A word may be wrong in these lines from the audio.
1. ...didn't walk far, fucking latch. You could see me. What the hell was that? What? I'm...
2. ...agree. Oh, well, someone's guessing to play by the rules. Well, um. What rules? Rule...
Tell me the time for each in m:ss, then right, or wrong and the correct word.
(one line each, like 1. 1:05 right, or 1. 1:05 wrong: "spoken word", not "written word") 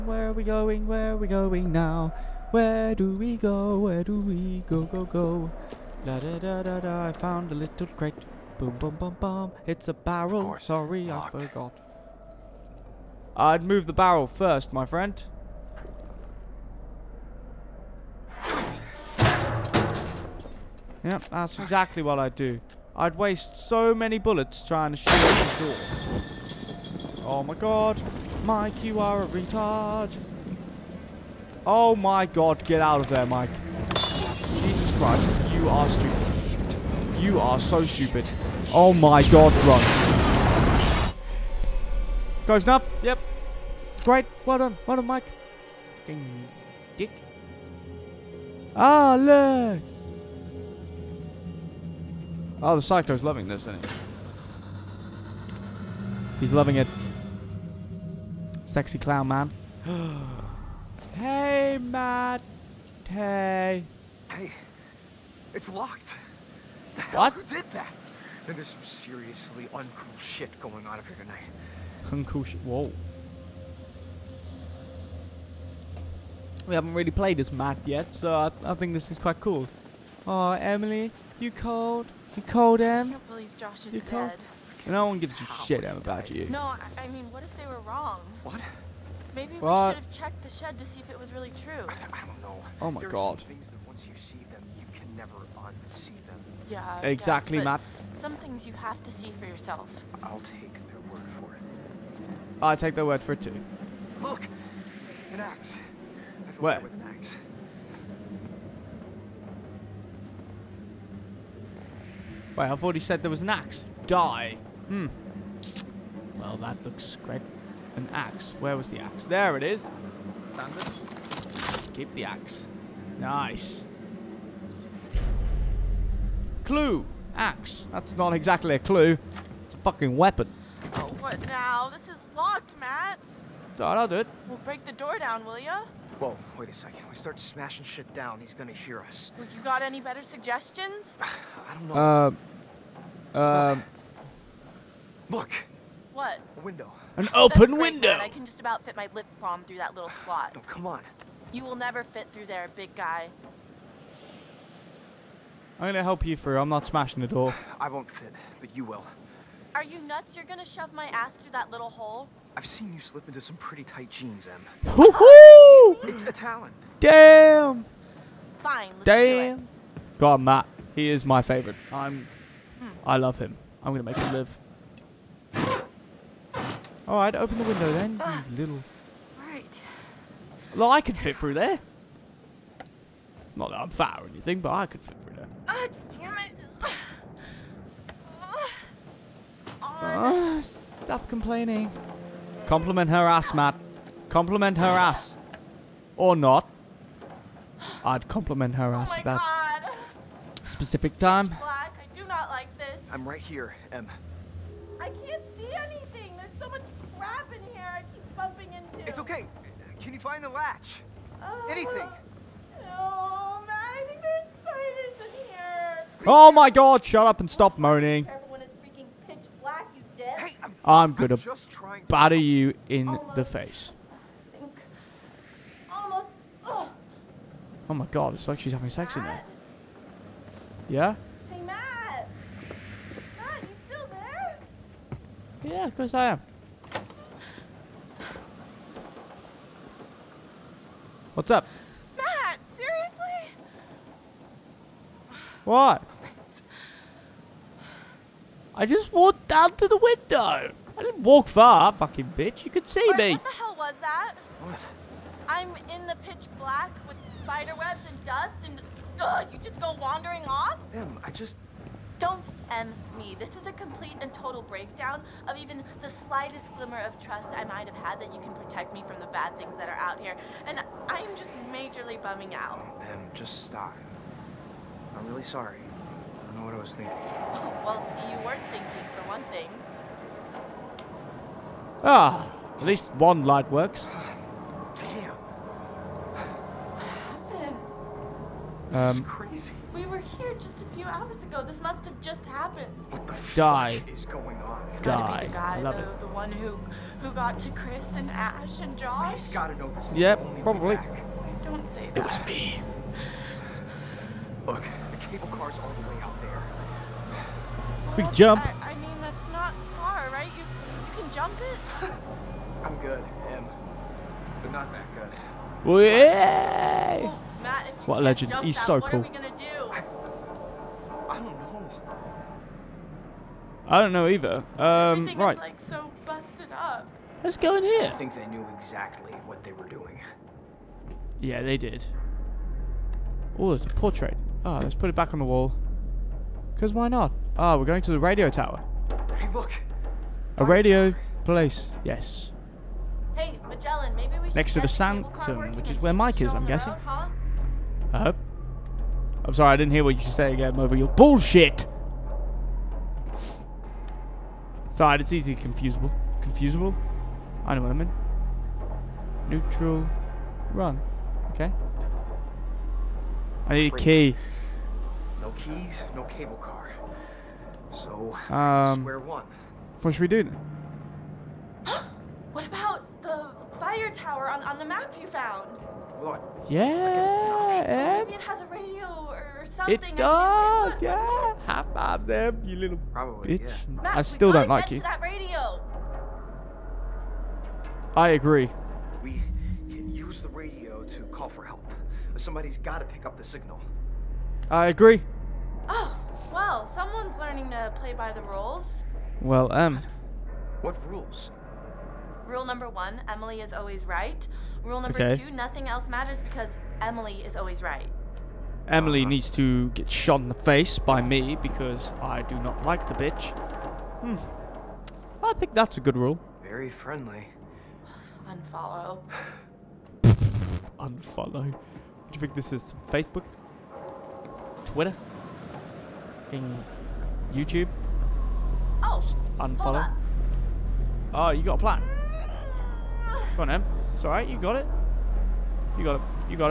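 1. 4:11 wrong: "bitch", not "latch"
2. 6:34 wrong: "learning", not "guessing".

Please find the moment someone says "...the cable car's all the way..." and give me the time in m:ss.
5:05.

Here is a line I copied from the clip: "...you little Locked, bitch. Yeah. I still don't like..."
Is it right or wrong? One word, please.
wrong.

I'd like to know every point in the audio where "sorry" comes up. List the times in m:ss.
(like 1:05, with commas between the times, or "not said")
0:10, 4:35, 5:49, 5:54.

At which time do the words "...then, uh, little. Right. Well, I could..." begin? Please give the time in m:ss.
2:57.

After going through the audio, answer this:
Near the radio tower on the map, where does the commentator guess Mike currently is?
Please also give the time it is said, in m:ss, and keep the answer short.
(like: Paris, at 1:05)
The Sanctum, at 5:44.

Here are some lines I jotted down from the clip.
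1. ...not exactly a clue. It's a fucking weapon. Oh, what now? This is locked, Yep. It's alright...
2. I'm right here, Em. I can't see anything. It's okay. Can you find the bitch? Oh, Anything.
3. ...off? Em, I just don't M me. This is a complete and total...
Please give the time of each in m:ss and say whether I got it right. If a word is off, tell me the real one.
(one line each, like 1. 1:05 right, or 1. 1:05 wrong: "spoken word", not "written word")
1. 2:08 wrong: "Matt", not "Yep"
2. 3:23 wrong: "latch", not "bitch"
3. 4:20 right.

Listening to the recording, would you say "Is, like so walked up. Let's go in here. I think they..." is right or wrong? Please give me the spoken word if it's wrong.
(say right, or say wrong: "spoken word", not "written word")
wrong: "busted", not "walked".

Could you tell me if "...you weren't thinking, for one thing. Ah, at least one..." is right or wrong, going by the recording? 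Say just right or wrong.
right.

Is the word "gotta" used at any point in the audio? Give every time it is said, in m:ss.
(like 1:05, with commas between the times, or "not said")
4:54, 4:59.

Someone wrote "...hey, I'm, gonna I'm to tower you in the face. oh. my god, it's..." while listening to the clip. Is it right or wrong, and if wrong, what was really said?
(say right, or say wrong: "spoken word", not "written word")
wrong: "batter", not "tower".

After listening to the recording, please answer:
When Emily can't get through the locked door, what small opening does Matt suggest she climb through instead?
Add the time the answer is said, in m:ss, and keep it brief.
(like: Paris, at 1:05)
A window, at 2:27.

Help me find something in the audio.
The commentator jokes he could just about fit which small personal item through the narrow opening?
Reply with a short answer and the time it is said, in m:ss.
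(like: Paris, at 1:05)
Lip balm, at 2:29.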